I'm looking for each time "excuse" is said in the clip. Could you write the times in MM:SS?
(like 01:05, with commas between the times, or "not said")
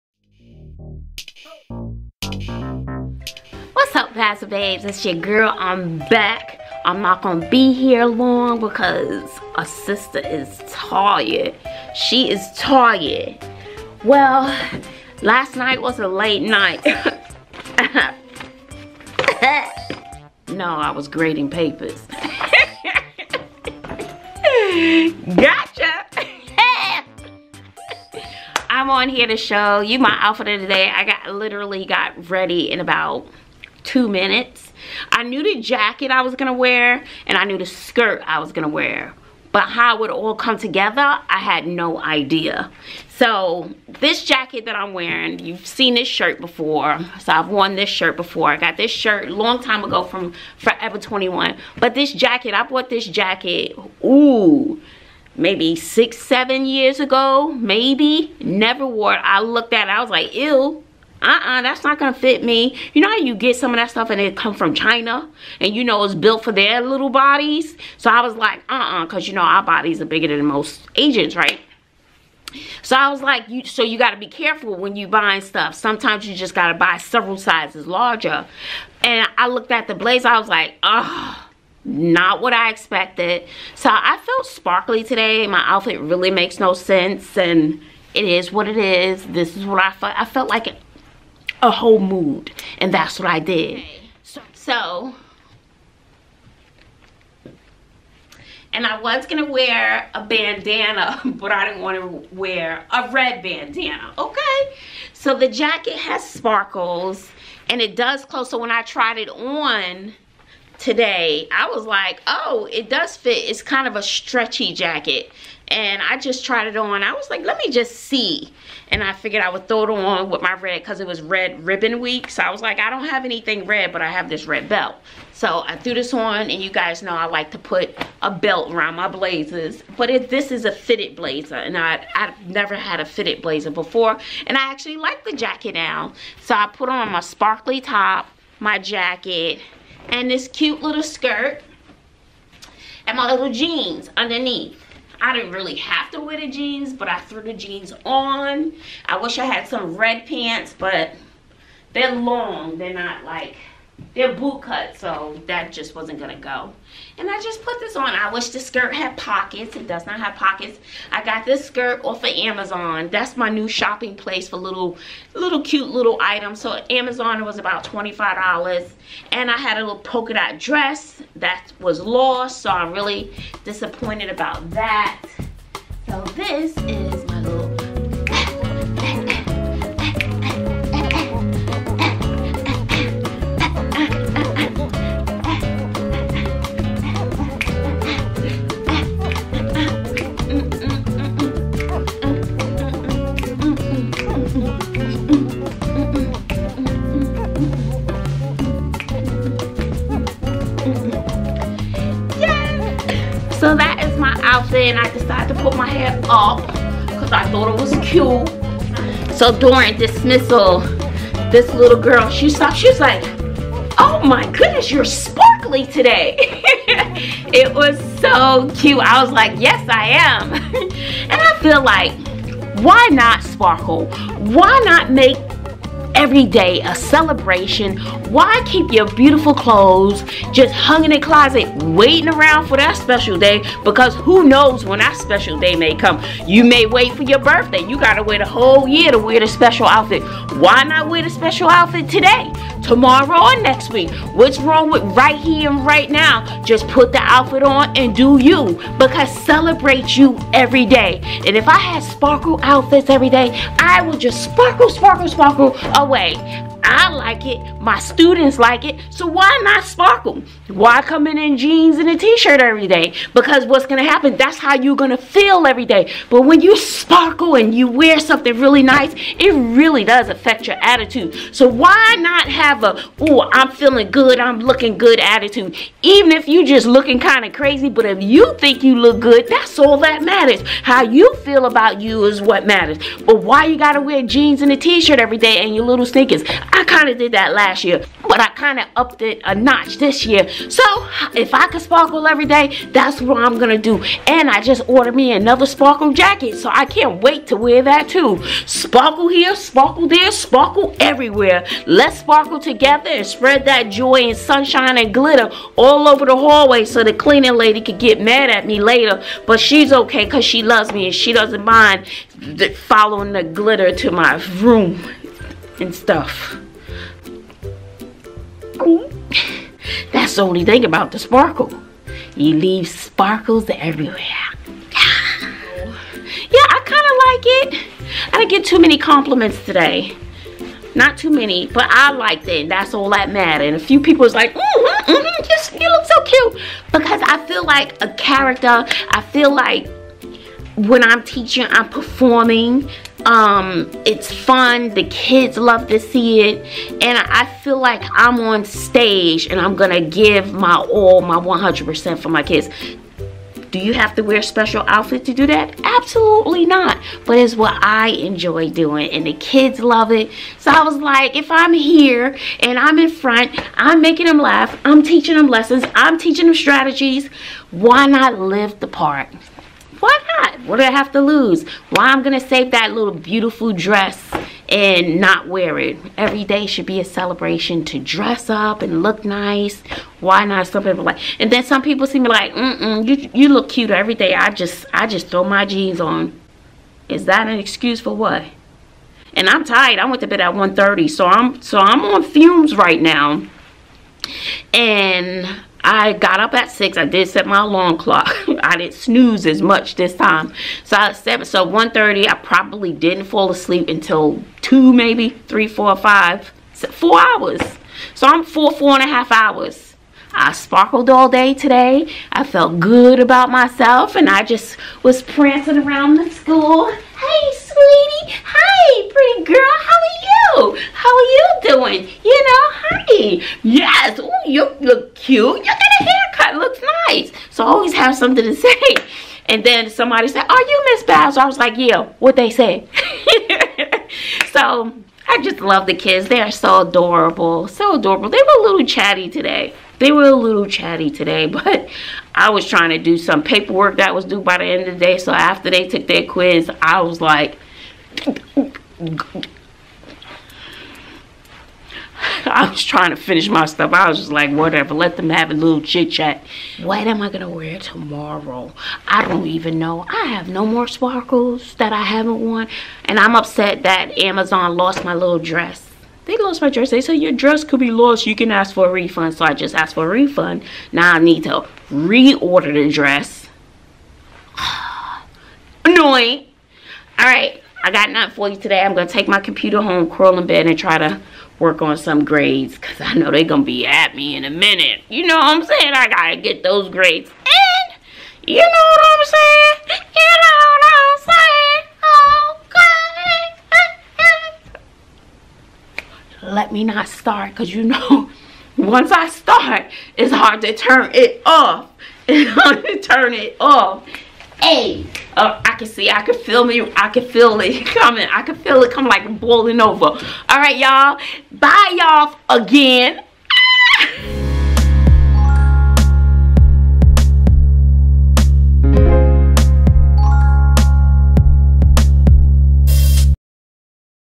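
06:27.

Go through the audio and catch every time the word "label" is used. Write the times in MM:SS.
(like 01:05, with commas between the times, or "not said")
not said.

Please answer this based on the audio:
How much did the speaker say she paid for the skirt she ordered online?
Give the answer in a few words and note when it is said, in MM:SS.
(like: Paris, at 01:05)
$25, at 02:47.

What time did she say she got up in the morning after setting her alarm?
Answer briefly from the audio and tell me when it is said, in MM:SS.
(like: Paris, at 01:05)
6, at 06:36.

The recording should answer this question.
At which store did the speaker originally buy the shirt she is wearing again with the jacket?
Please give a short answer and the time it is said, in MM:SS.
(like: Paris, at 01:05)
Forever 21, at 00:50.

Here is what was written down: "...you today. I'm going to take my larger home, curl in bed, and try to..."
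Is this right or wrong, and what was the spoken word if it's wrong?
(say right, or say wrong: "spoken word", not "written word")
wrong: "computer", not "larger".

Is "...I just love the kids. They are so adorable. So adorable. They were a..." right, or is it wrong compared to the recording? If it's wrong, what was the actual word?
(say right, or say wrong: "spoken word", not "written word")
right.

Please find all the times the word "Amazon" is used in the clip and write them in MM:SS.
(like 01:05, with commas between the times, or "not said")
02:42, 02:46, 07:44.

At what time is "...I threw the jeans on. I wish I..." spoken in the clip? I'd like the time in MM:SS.
02:27.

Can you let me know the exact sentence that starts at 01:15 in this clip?
Sometimes you just gotta buy several sizes larger.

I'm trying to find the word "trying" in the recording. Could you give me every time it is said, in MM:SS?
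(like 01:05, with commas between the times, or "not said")
07:22, 07:32.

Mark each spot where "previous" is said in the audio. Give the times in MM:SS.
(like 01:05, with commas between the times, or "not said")
not said.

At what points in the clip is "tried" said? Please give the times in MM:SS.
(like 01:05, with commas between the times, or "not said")
01:48, 01:56.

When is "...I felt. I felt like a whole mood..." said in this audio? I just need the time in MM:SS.
01:29.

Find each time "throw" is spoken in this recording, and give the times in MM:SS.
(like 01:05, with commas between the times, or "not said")
01:59, 06:25.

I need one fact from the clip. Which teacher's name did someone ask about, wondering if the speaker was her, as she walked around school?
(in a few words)
Miss Bowser.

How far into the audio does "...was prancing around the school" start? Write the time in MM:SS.
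06:55.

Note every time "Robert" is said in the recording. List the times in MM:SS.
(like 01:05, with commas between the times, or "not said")
not said.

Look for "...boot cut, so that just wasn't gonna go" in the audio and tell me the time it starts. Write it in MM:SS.
02:34.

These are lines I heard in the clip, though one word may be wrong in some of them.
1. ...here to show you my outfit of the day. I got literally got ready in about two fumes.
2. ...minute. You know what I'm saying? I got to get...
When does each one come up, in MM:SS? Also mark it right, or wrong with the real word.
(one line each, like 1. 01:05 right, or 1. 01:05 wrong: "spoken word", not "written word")
1. 00:29 wrong: "minutes", not "fumes"
2. 08:04 right.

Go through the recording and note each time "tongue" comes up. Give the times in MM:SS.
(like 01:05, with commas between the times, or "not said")
not said.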